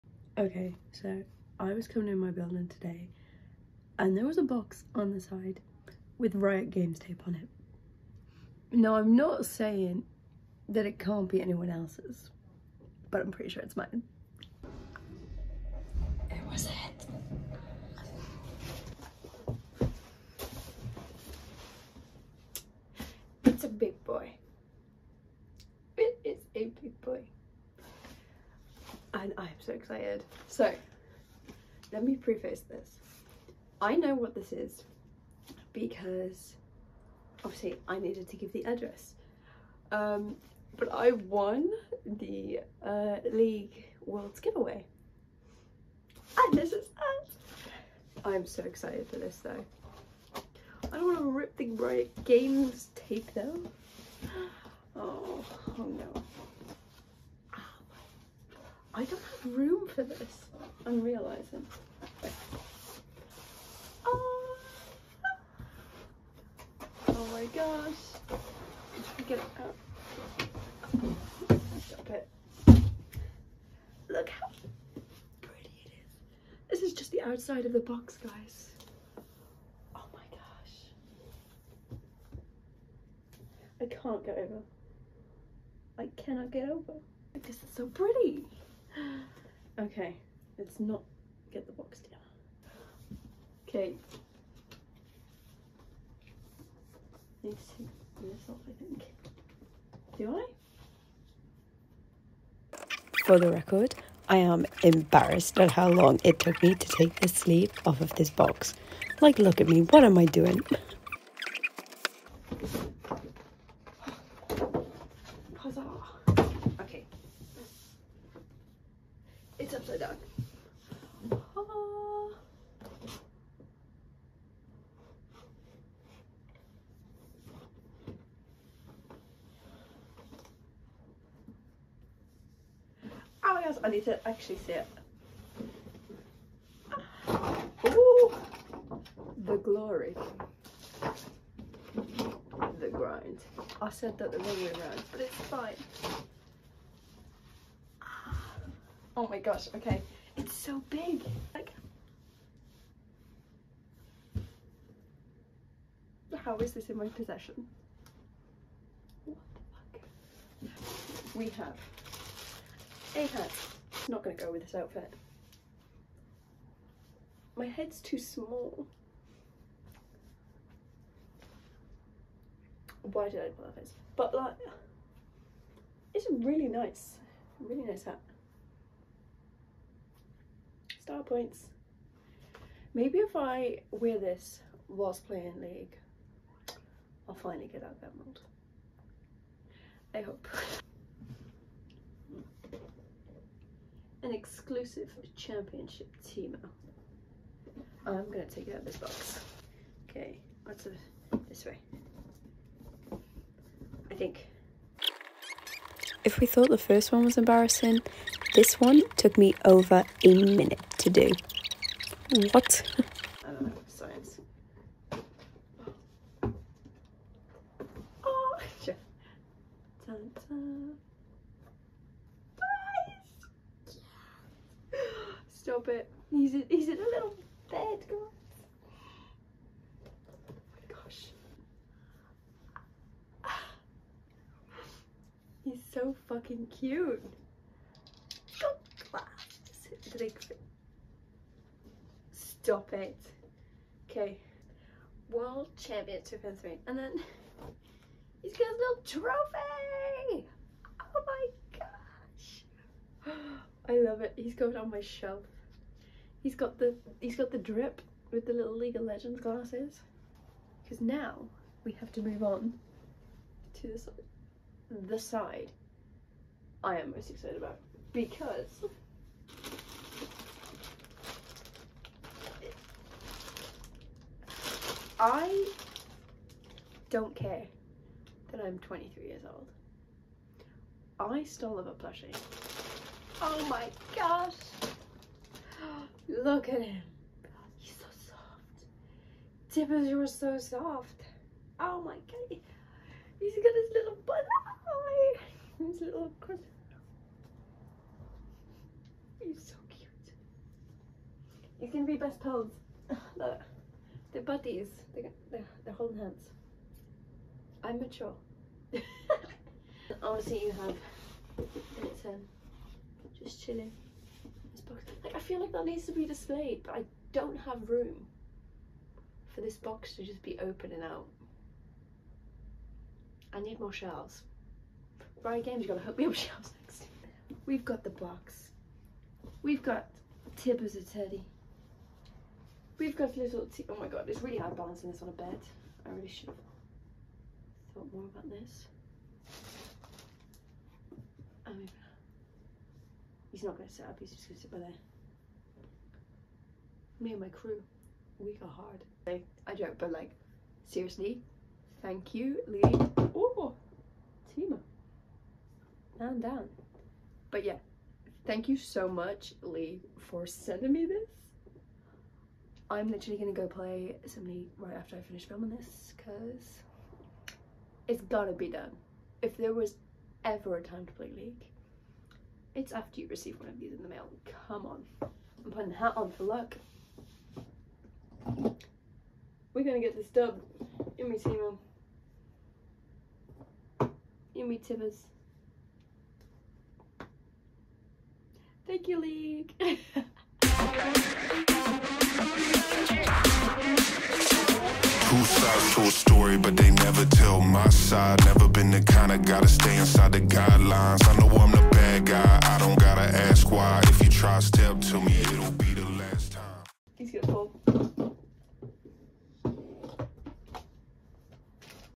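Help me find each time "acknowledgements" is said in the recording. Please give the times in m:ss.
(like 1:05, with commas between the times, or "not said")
not said.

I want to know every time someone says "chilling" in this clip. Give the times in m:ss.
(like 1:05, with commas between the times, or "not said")
5:13.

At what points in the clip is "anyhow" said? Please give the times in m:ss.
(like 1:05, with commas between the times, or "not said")
not said.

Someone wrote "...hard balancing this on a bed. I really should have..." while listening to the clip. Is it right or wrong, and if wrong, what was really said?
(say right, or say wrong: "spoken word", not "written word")
right.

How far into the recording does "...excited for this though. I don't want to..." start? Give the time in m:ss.
0:48.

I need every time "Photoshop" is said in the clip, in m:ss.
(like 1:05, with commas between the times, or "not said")
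not said.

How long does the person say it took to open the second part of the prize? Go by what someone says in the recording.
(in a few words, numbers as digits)
over a minute.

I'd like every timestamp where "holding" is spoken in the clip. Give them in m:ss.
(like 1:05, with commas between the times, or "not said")
5:05.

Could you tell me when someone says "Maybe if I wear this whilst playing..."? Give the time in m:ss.
3:02.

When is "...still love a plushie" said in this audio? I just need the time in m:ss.
4:41.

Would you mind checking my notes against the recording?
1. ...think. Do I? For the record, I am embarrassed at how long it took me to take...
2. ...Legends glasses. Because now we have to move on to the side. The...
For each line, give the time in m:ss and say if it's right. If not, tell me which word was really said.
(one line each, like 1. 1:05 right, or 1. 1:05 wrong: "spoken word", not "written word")
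1. 1:38 right
2. 4:19 right.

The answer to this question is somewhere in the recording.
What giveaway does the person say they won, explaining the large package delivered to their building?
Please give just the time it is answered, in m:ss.
0:43.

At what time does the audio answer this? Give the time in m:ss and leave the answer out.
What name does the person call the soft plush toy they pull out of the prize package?
4:49.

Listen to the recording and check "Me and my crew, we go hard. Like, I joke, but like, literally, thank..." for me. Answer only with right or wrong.
wrong.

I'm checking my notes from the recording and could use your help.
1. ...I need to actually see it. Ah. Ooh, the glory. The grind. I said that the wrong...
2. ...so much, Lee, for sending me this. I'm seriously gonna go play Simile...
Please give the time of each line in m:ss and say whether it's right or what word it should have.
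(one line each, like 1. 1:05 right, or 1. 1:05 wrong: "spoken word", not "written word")
1. 2:13 right
2. 5:58 wrong: "literally", not "seriously".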